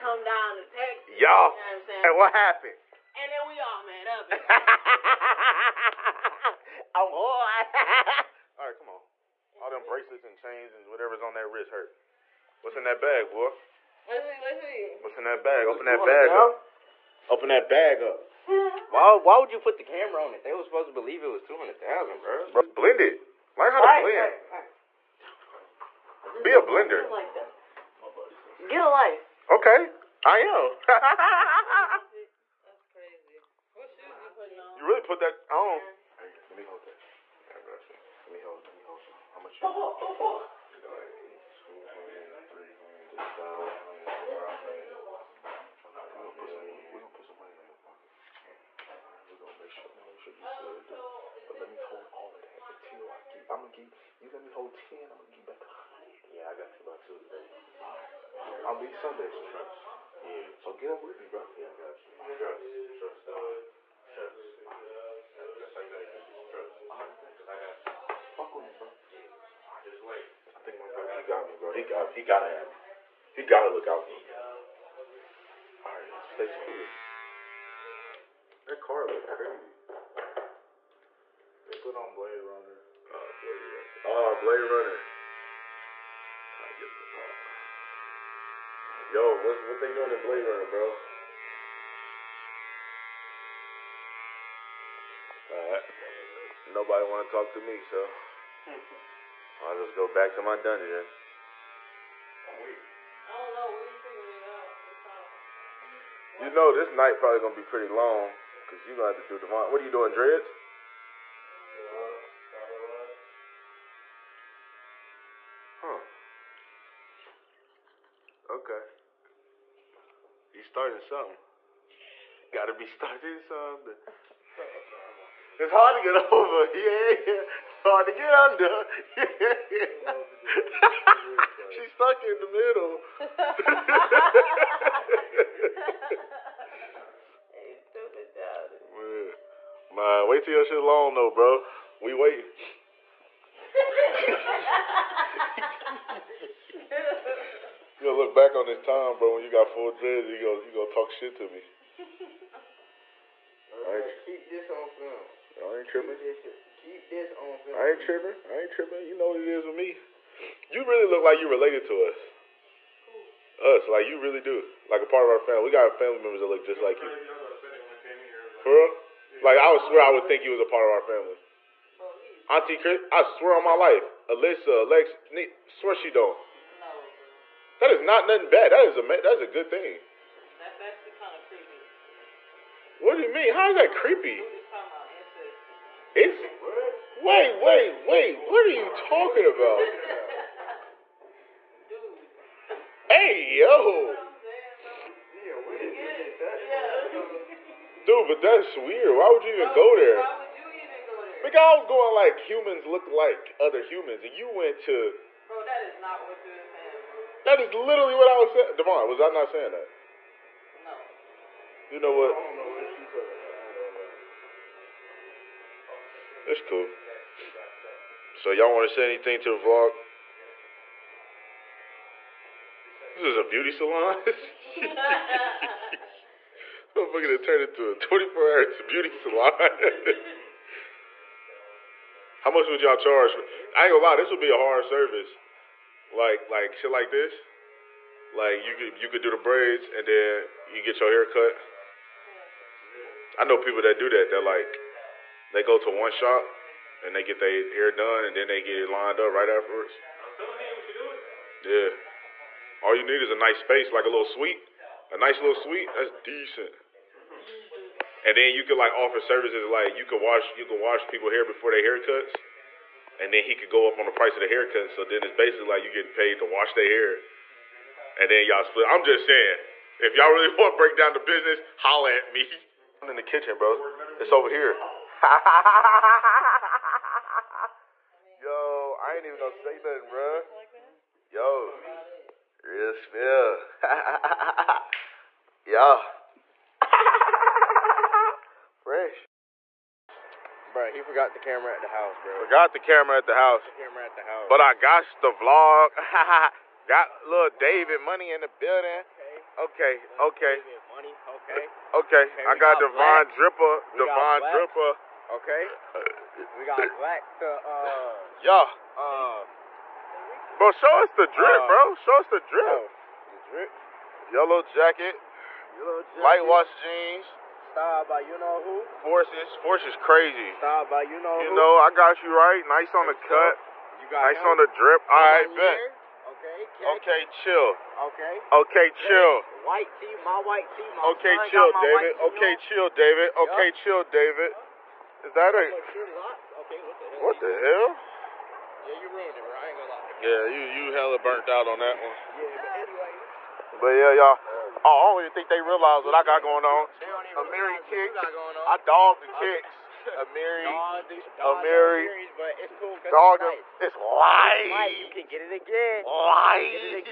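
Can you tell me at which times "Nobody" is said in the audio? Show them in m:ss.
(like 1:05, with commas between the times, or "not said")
1:36.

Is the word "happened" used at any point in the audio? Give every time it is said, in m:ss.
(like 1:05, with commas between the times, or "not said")
0:02.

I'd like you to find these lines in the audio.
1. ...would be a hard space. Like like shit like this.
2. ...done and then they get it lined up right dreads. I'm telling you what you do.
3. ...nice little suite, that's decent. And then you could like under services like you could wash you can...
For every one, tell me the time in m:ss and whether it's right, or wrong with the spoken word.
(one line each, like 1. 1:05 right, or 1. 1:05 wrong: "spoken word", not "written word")
1. 3:54 wrong: "service", not "space"
2. 4:07 wrong: "afterwards", not "dreads"
3. 4:15 wrong: "offer", not "under".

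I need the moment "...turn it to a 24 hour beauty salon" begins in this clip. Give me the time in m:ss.
3:47.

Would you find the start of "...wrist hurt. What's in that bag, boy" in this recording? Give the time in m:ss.
0:11.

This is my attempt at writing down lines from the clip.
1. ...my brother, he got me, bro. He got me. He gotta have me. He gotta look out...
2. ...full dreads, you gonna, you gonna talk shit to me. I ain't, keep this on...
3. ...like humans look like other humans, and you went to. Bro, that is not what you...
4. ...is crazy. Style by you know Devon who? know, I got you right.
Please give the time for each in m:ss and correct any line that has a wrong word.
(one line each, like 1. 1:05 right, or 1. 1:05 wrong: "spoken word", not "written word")
1. 1:10 right
2. 2:29 right
3. 3:22 right
4. 5:19 wrong: "You", not "Devon".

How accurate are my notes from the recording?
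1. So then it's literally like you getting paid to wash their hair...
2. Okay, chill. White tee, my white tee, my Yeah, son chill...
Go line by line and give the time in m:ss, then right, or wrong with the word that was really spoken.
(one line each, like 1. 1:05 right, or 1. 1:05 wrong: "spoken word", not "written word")
1. 4:24 wrong: "basically", not "literally"
2. 5:28 wrong: "Okay", not "Yeah".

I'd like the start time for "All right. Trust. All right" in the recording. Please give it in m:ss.
1:03.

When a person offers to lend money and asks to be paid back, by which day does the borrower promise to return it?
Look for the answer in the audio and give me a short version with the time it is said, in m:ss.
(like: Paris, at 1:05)
Tuesday, at 0:57.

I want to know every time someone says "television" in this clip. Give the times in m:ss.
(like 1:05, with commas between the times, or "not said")
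not said.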